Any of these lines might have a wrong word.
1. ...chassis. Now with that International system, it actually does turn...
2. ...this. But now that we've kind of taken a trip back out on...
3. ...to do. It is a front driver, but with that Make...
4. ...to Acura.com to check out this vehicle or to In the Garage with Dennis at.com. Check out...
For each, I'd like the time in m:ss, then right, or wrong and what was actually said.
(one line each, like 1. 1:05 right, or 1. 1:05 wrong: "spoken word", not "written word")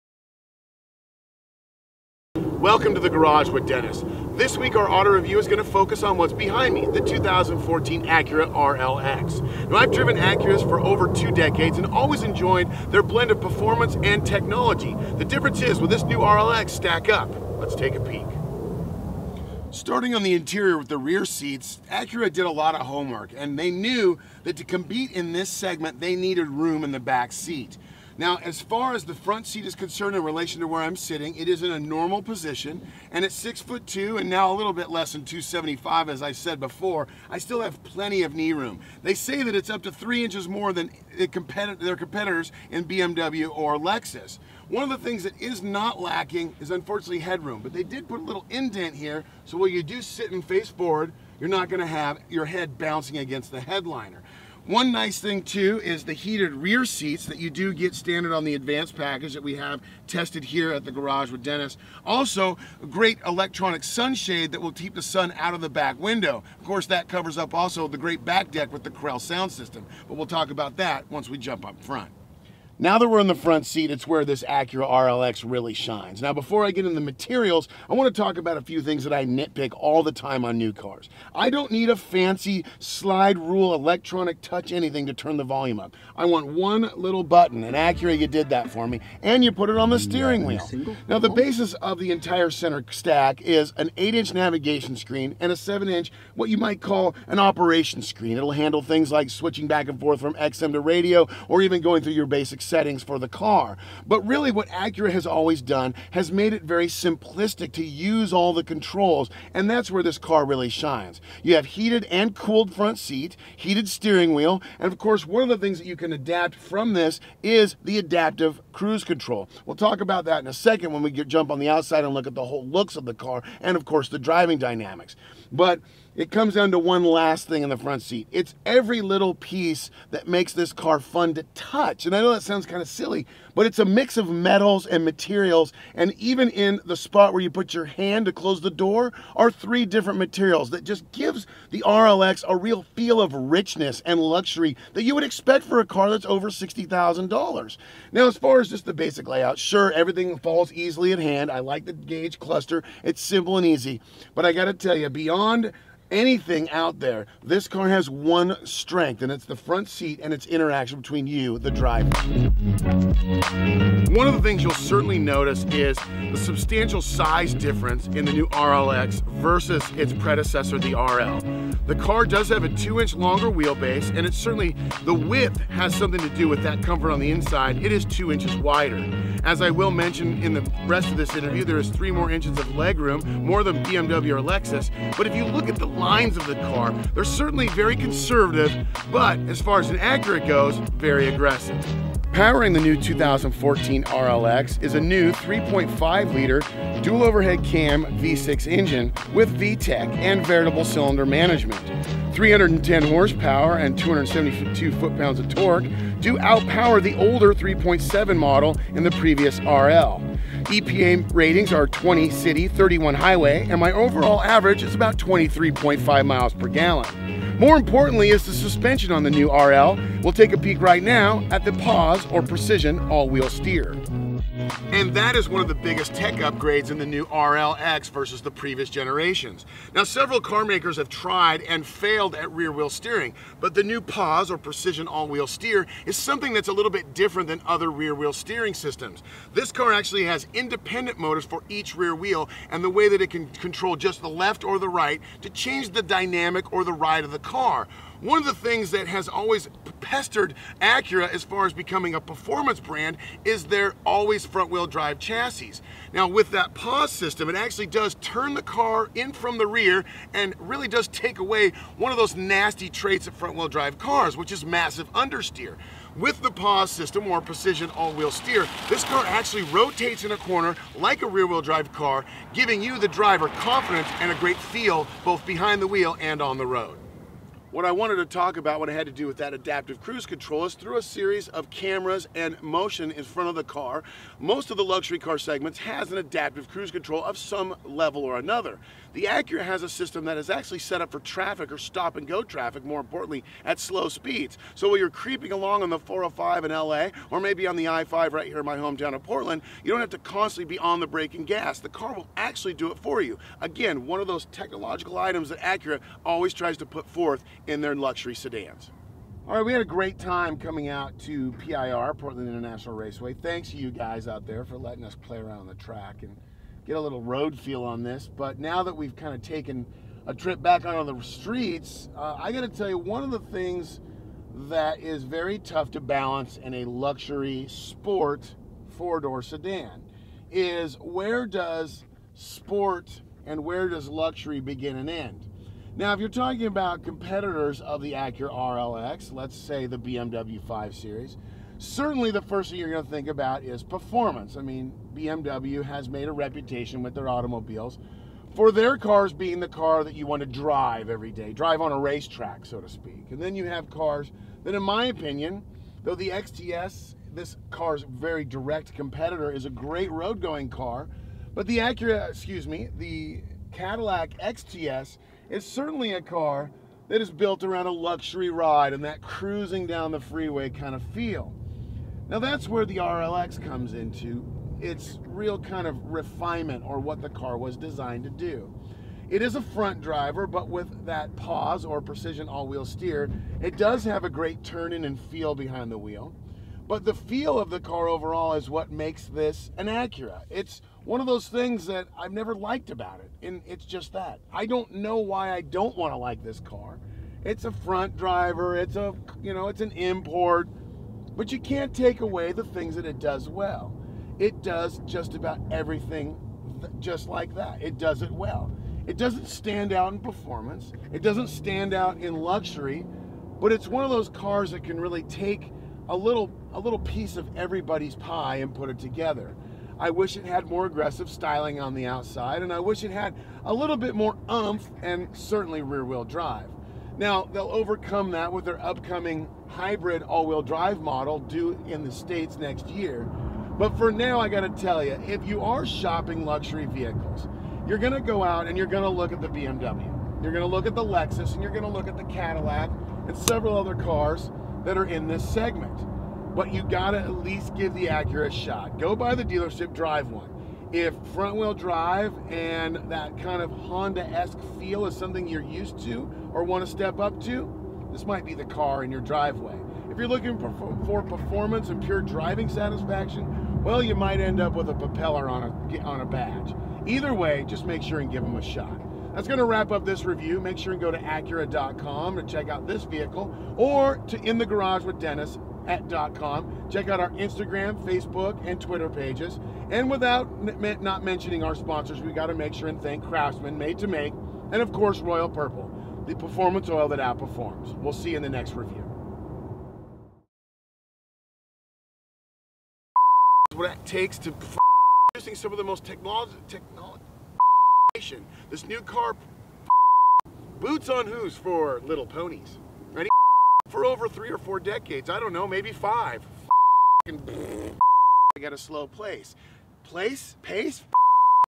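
1. 4:15 wrong: "PAWS", not "International"
2. 5:18 right
3. 6:18 wrong: "PAWS", not "Make"
4. 7:51 right.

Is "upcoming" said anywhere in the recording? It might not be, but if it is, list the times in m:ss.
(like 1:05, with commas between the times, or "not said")
7:08.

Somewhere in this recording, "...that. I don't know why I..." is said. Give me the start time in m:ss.
6:34.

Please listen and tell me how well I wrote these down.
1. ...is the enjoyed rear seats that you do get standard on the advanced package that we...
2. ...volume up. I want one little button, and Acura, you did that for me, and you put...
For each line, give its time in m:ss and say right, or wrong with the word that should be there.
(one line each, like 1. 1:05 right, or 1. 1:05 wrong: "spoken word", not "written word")
1. 0:55 wrong: "heated", not "enjoyed"
2. 1:25 right.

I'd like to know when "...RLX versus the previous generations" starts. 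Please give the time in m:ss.
3:47.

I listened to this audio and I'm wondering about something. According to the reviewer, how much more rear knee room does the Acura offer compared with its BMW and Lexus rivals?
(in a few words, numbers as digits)
3 inches.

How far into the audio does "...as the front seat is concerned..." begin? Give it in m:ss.
0:28.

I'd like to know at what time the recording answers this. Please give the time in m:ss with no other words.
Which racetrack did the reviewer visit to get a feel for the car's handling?
5:12.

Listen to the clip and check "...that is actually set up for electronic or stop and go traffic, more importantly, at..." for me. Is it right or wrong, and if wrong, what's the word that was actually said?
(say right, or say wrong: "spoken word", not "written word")
wrong: "traffic", not "electronic".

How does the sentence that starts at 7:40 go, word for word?
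If you're looking for performance and pure driving satisfaction, well, you might end up with a propeller on a, on a badge.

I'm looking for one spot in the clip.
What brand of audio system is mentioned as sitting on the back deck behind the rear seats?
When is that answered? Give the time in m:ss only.
1:08.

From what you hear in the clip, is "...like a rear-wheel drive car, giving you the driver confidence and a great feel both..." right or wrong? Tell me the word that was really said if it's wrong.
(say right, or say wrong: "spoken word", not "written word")
right.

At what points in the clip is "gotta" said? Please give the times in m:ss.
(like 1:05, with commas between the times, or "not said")
7:14, 7:26.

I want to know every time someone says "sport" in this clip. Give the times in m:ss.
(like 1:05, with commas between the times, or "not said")
5:27, 5:32.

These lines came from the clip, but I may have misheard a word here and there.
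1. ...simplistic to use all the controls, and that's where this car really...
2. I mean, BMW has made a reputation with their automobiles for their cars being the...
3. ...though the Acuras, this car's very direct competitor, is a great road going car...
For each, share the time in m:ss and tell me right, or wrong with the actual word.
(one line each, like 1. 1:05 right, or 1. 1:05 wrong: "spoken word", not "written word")
1. 1:46 right
2. 5:44 right
3. 5:56 wrong: "XTS", not "Acuras".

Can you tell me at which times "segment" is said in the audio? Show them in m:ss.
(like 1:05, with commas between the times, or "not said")
0:25, 4:45, 7:25.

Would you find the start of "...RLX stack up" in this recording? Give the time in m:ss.
0:16.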